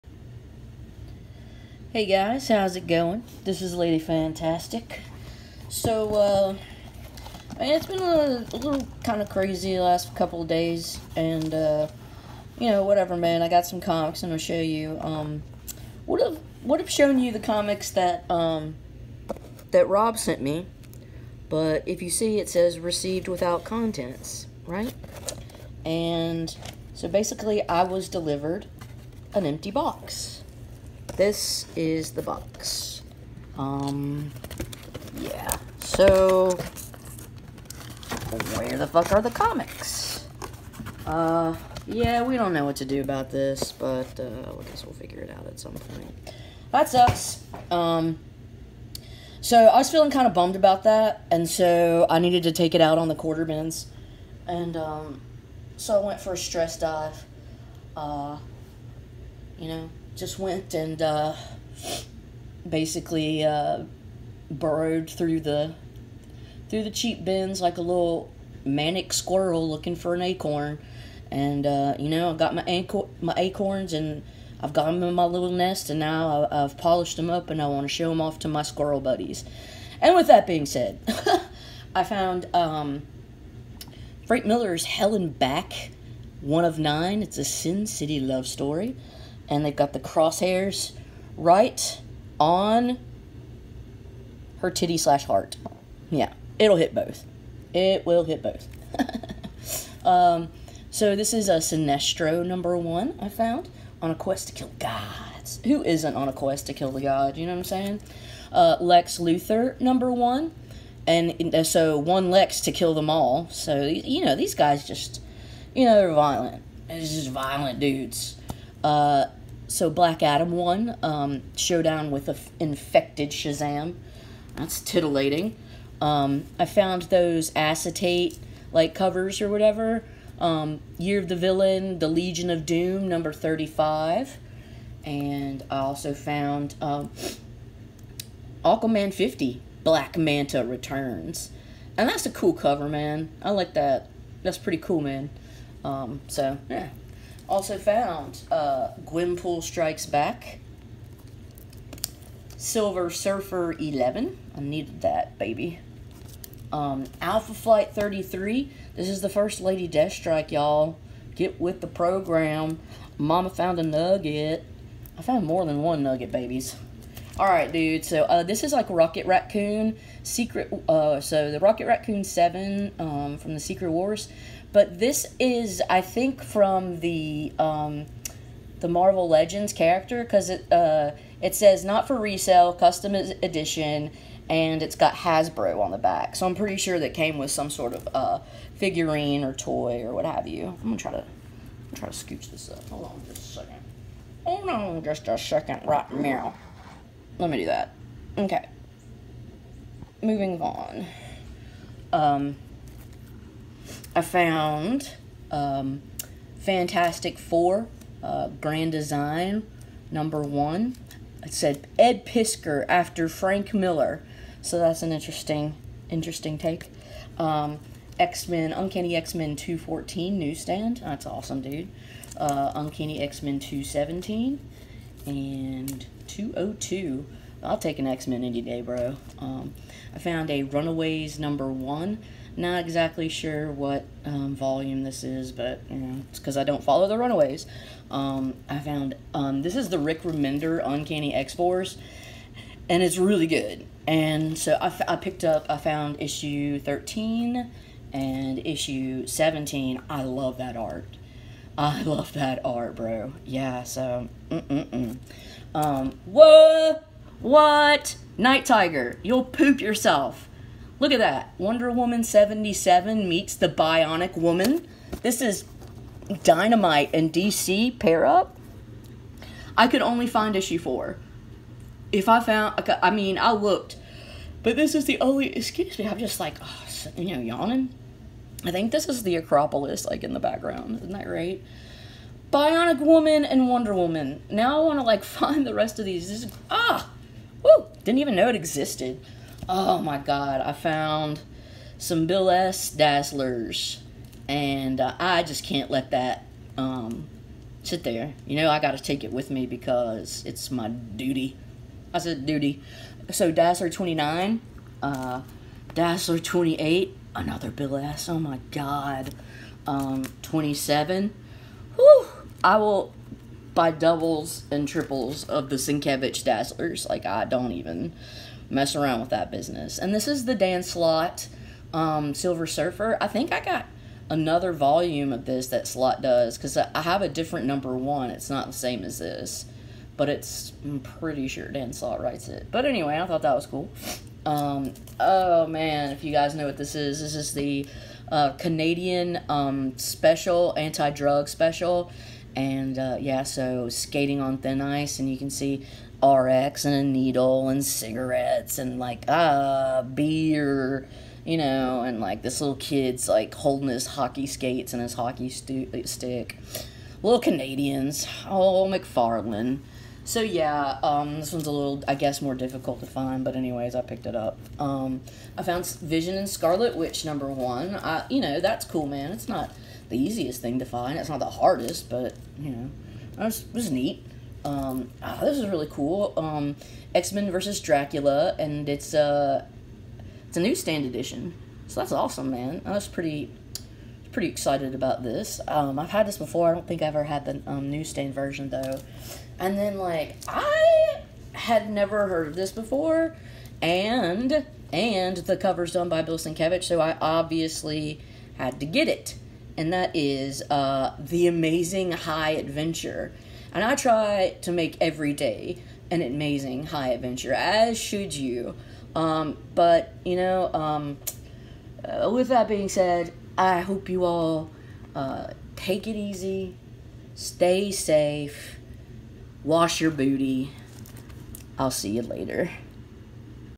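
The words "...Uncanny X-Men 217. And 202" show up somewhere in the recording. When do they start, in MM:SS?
03:42.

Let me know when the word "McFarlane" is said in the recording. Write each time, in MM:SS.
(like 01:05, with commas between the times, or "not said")
05:58.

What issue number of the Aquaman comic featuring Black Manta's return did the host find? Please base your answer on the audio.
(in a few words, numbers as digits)
50.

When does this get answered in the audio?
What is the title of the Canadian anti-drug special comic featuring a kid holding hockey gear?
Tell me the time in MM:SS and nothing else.
05:43.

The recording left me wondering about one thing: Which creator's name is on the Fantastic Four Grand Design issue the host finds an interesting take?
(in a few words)
Ed Piskor.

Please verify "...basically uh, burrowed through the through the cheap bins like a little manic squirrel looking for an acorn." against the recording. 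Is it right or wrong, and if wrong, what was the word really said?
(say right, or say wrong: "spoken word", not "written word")
right.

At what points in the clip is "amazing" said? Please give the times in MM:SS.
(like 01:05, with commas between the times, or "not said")
06:41, 06:46.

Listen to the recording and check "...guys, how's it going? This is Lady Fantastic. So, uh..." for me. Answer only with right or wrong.
right.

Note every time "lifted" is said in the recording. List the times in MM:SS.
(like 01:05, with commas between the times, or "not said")
not said.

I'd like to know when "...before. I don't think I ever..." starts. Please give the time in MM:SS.
06:26.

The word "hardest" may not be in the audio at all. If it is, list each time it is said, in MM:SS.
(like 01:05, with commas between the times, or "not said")
06:11.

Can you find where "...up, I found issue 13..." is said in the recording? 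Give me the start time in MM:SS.
04:05.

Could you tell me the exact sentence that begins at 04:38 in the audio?
I think this is the Acropolis, like, in the background.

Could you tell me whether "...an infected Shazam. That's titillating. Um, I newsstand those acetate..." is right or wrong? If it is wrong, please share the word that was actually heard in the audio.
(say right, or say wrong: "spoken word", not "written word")
wrong: "found", not "newsstand".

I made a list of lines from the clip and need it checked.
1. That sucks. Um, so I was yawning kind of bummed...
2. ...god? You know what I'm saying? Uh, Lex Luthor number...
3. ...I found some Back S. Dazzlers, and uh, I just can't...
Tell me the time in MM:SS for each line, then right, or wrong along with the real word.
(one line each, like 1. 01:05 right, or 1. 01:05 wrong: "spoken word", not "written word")
1. 00:46 wrong: "feeling", not "yawning"
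2. 01:47 right
3. 04:50 wrong: "Bill", not "Back".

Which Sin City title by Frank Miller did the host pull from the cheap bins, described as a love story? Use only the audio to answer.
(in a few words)
Hell and Back.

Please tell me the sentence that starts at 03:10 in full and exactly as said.
I'm gonna try to, I'm try to scooch this up.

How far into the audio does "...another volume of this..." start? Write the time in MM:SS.
05:24.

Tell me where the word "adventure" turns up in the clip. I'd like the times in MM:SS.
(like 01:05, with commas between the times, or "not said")
06:42, 06:47.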